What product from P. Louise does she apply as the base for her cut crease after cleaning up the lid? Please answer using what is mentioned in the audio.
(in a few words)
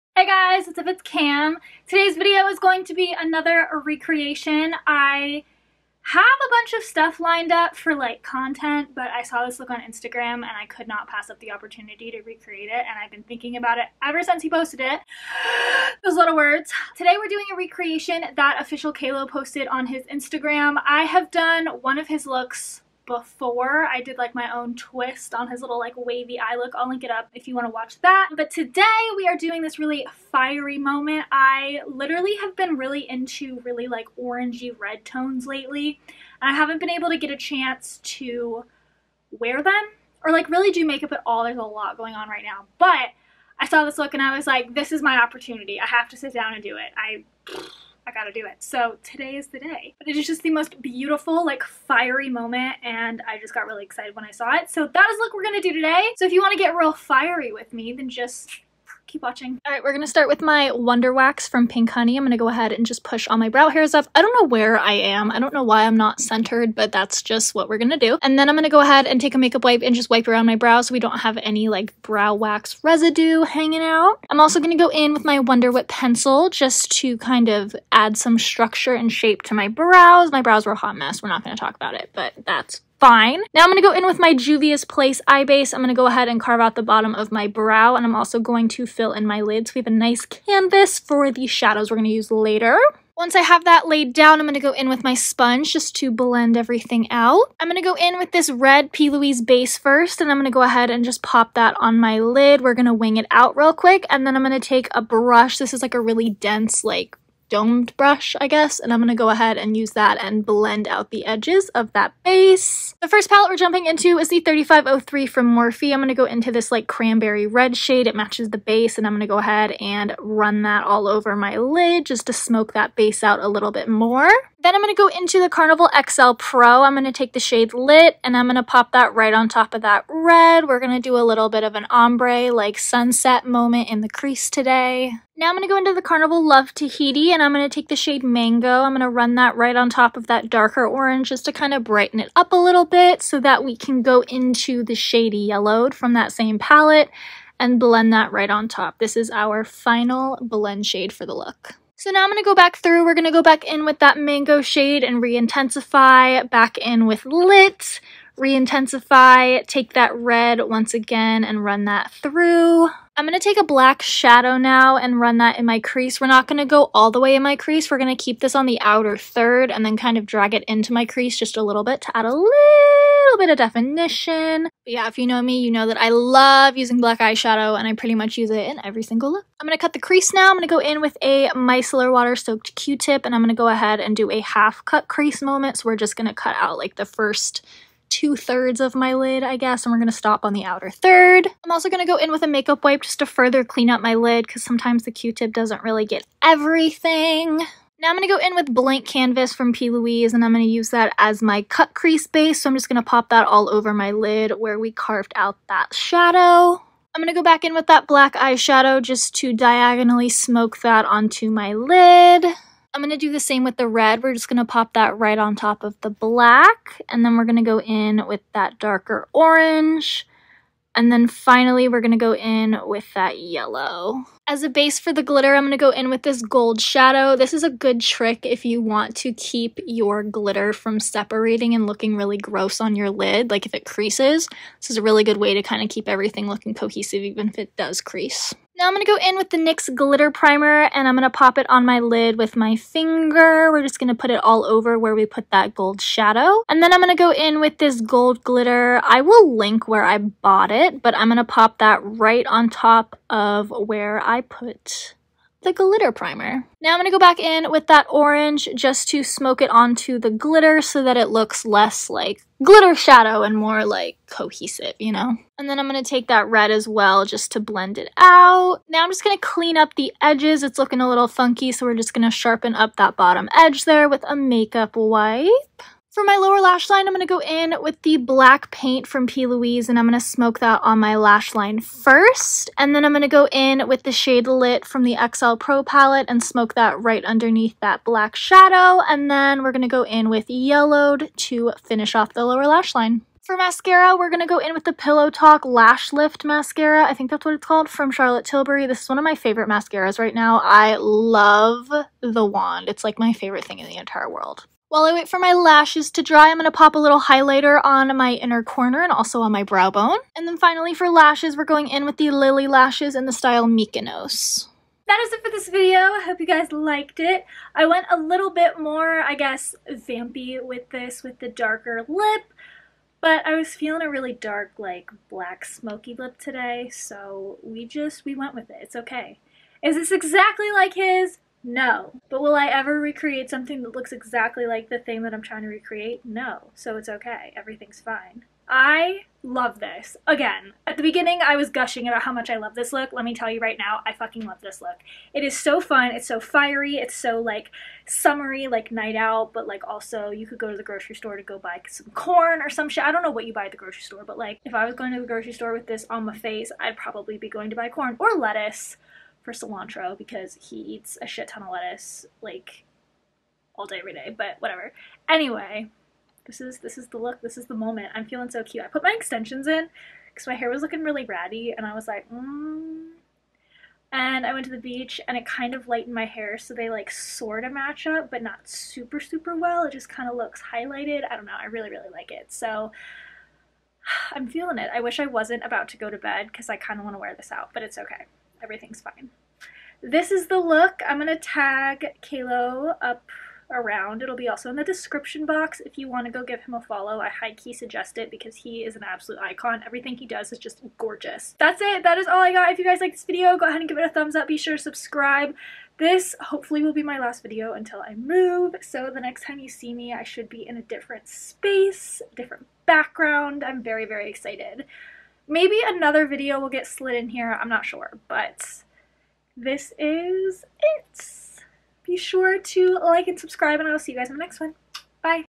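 Blank Canvas.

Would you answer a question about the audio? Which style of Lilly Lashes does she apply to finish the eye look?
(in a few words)
Mykonos.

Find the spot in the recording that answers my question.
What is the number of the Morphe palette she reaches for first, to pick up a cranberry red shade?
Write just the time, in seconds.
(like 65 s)
114 s.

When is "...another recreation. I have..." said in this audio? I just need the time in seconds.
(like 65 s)
3 s.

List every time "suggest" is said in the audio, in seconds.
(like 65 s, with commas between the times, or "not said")
397 s.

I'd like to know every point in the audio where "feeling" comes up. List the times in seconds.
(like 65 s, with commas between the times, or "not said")
323 s, 368 s, 384 s.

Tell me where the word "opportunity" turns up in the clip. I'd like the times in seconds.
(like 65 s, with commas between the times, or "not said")
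11 s, 45 s.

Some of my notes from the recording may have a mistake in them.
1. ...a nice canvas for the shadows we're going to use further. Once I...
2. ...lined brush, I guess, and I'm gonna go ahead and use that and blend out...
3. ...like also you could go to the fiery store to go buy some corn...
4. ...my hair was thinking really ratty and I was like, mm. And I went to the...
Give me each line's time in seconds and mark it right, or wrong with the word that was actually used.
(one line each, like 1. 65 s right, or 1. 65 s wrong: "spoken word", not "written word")
1. 89 s wrong: "later", not "further"
2. 107 s wrong: "domed", not "lined"
3. 349 s wrong: "grocery", not "fiery"
4. 370 s wrong: "looking", not "thinking".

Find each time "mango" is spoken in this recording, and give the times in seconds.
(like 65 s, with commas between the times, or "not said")
138 s, 154 s.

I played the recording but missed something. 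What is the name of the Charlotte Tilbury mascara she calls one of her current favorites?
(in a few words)
Pillow Talk Lash Lift.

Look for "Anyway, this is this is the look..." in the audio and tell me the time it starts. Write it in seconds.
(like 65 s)
365 s.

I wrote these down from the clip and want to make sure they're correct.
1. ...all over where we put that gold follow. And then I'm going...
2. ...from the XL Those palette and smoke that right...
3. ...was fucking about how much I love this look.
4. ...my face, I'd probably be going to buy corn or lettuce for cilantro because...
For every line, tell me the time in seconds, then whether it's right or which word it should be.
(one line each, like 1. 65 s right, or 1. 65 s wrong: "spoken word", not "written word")
1. 244 s wrong: "shadow", not "follow"
2. 284 s wrong: "Pro", not "Those"
3. 341 s wrong: "gushing", not "fucking"
4. 356 s right.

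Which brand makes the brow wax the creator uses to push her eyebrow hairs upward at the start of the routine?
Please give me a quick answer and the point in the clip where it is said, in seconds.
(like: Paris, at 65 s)
Pink Honey, at 61 s.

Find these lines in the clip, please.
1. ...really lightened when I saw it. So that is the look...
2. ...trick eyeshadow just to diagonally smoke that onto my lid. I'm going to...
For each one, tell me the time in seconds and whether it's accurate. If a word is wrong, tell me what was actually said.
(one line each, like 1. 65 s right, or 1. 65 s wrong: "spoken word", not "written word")
1. 53 s wrong: "excited", not "lightened"
2. 208 s wrong: "black", not "trick".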